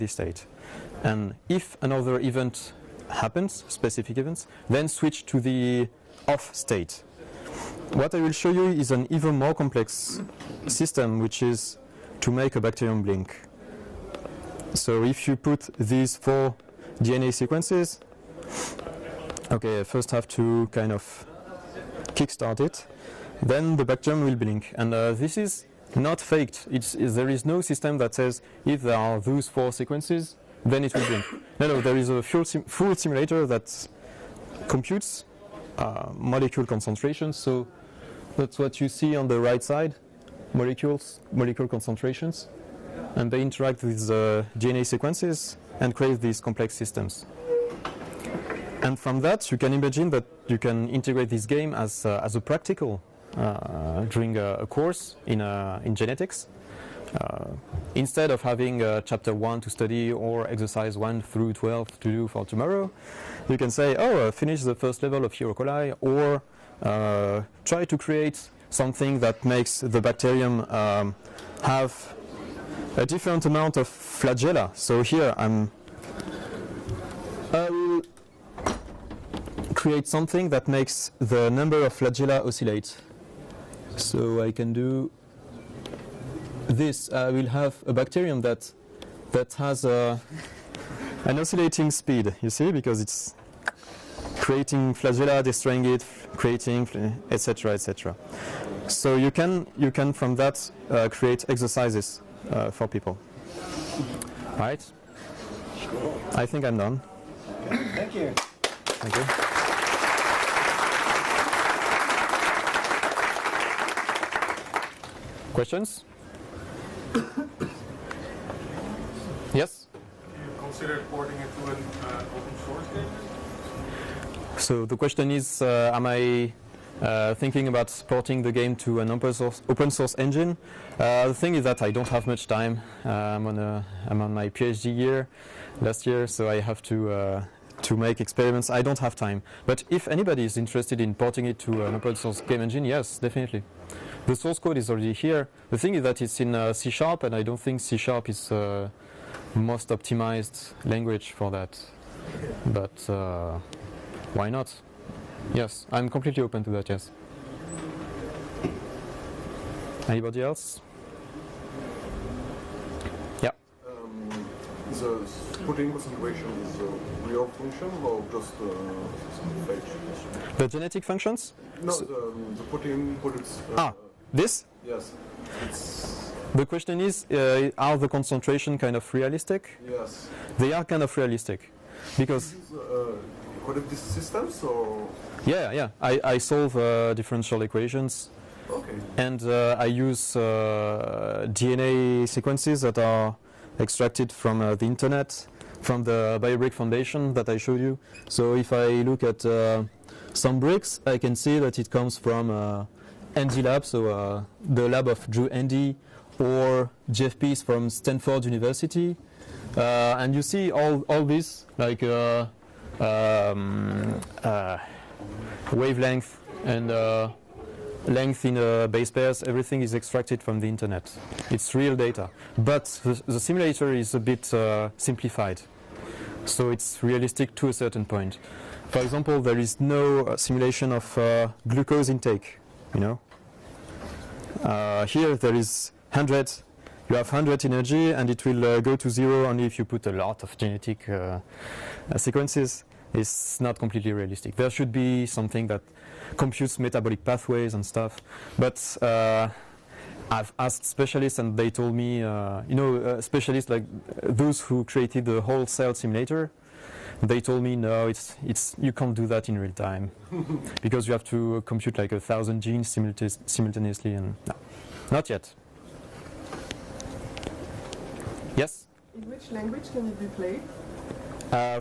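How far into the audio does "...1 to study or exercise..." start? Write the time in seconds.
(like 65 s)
59 s.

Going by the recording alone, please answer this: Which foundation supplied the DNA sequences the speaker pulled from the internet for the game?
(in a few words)
BioBrick Foundation.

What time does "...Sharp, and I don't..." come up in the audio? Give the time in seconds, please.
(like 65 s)
146 s.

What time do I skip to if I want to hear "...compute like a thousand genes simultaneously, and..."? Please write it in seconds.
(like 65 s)
261 s.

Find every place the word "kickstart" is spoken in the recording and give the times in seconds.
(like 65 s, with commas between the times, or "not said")
22 s.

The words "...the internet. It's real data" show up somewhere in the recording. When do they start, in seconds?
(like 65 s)
220 s.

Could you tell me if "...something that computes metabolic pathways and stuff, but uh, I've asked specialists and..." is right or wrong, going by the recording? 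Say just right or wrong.
right.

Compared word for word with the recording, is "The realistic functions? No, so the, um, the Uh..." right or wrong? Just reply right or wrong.
wrong.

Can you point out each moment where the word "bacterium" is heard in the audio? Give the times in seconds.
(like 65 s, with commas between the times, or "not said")
12 s, 23 s, 69 s, 87 s.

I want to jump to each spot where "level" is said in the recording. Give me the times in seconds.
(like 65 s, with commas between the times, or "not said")
65 s.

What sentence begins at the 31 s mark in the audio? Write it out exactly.
No, no, there is a full, sim full simulator that computes uh, molecule concentrations.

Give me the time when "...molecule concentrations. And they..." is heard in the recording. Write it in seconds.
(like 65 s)
41 s.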